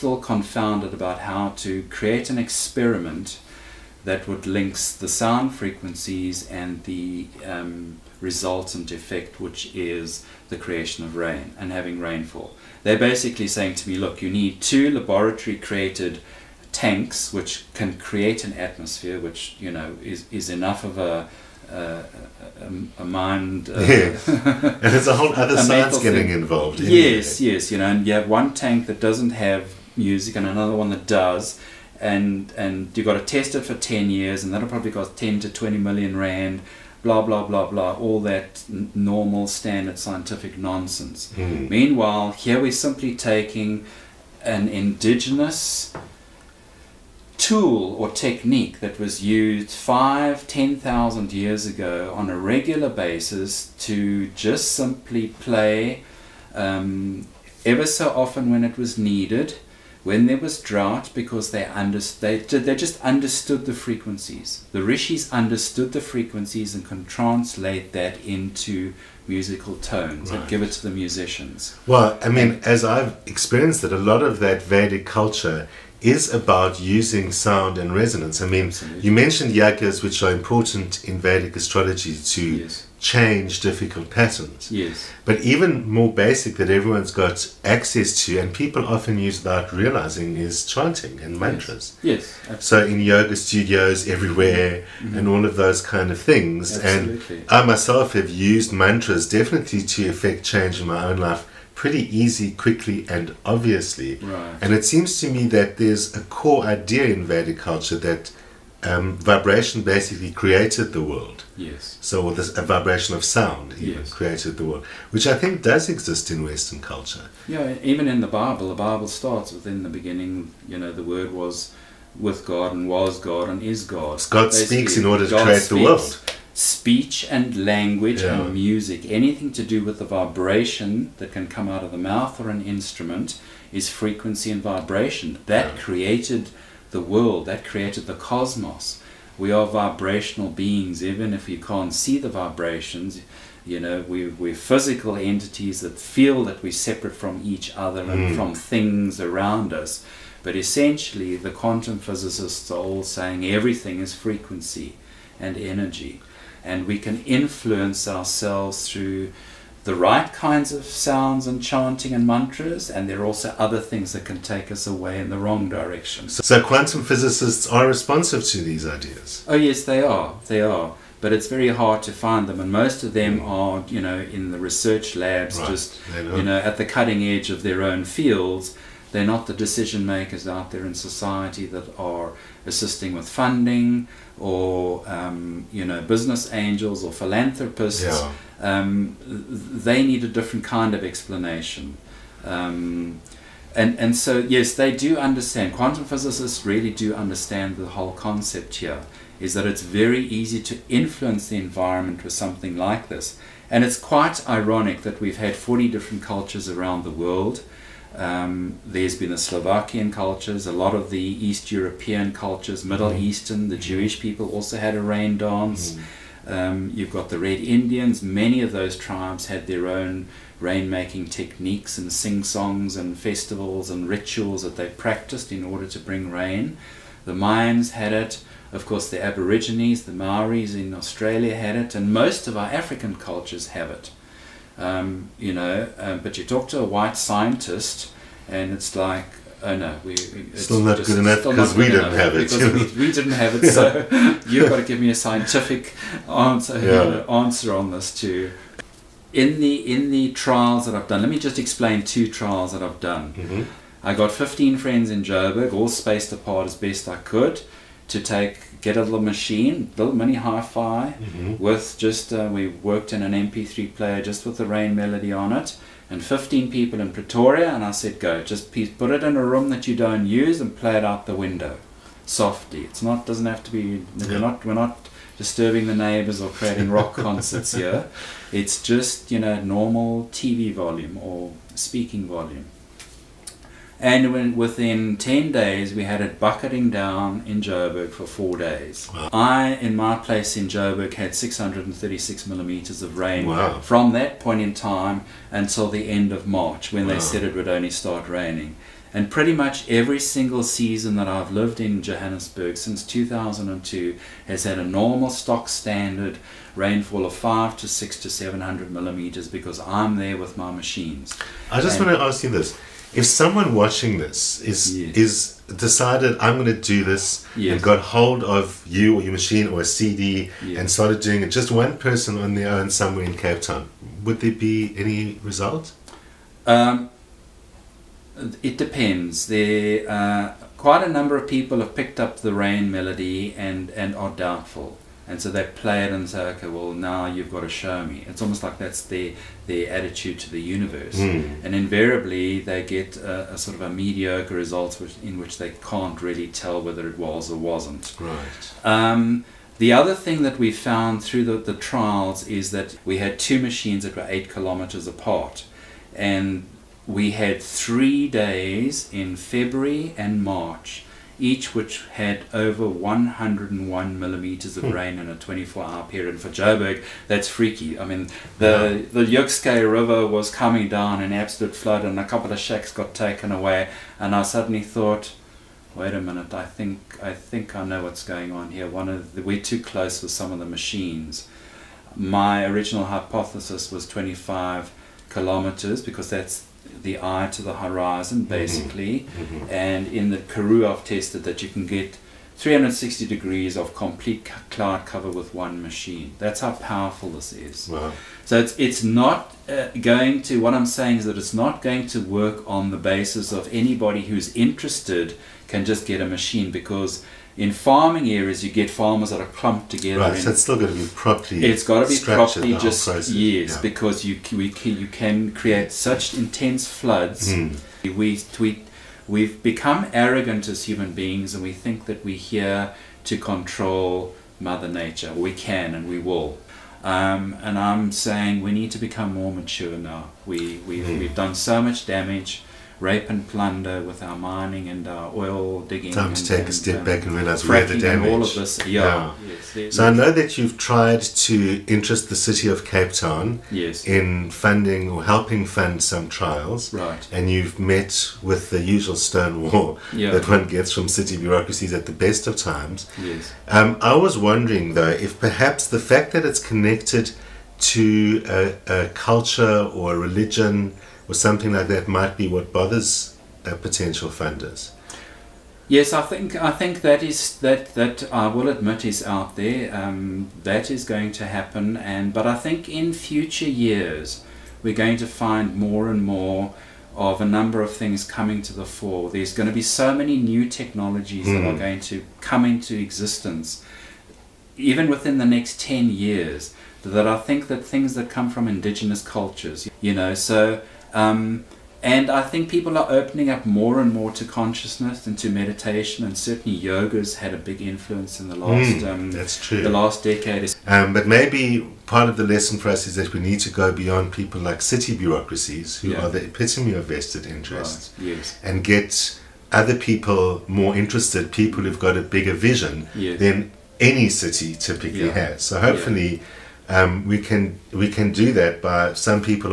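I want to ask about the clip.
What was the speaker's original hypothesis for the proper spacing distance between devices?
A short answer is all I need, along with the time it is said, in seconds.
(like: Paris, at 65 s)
25 kilometers, at 384 s.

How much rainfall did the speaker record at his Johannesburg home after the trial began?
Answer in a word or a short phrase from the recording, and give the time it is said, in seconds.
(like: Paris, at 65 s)
636 millimeters, at 291 s.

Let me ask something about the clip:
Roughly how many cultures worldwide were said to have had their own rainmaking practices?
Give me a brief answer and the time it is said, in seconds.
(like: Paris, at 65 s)
40, at 205 s.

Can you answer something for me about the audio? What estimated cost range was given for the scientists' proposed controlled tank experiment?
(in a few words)
10 to 20 million rand.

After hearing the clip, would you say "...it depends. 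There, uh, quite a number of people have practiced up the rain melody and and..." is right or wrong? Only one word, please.
wrong.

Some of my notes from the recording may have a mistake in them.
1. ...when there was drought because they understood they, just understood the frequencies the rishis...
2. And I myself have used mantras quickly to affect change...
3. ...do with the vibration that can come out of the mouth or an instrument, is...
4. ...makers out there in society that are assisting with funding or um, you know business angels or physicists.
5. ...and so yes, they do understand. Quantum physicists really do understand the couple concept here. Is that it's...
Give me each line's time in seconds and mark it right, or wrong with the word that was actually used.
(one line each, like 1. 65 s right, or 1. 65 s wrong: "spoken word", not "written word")
1. 60 s right
2. 97 s wrong: "definitely", not "quickly"
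3. 129 s right
4. 180 s wrong: "philanthropists", not "physicists"
5. 193 s wrong: "whole", not "couple".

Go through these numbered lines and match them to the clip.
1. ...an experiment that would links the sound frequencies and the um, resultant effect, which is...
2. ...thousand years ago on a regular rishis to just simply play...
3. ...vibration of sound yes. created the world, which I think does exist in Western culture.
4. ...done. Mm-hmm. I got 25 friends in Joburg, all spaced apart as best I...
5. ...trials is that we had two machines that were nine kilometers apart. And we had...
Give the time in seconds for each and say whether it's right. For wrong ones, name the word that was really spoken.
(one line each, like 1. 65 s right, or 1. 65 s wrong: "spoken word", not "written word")
1. 2 s right
2. 50 s wrong: "basis", not "rishis"
3. 112 s right
4. 252 s wrong: "15", not "25"
5. 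351 s wrong: "eight", not "nine".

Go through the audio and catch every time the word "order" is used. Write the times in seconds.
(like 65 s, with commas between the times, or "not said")
125 s, 225 s.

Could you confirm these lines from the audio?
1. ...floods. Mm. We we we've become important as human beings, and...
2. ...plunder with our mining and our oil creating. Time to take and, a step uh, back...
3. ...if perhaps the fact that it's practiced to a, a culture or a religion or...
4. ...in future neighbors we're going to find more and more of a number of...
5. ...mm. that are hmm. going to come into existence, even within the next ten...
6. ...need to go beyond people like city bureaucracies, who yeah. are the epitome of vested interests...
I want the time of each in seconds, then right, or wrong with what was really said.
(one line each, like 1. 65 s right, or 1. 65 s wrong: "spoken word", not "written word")
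1. 416 s wrong: "arrogant", not "important"
2. 433 s wrong: "digging", not "creating"
3. 455 s wrong: "connected", not "practiced"
4. 472 s wrong: "years", not "neighbors"
5. 481 s right
6. 503 s right.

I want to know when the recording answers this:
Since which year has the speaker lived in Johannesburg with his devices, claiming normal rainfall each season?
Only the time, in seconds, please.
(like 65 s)
303 s.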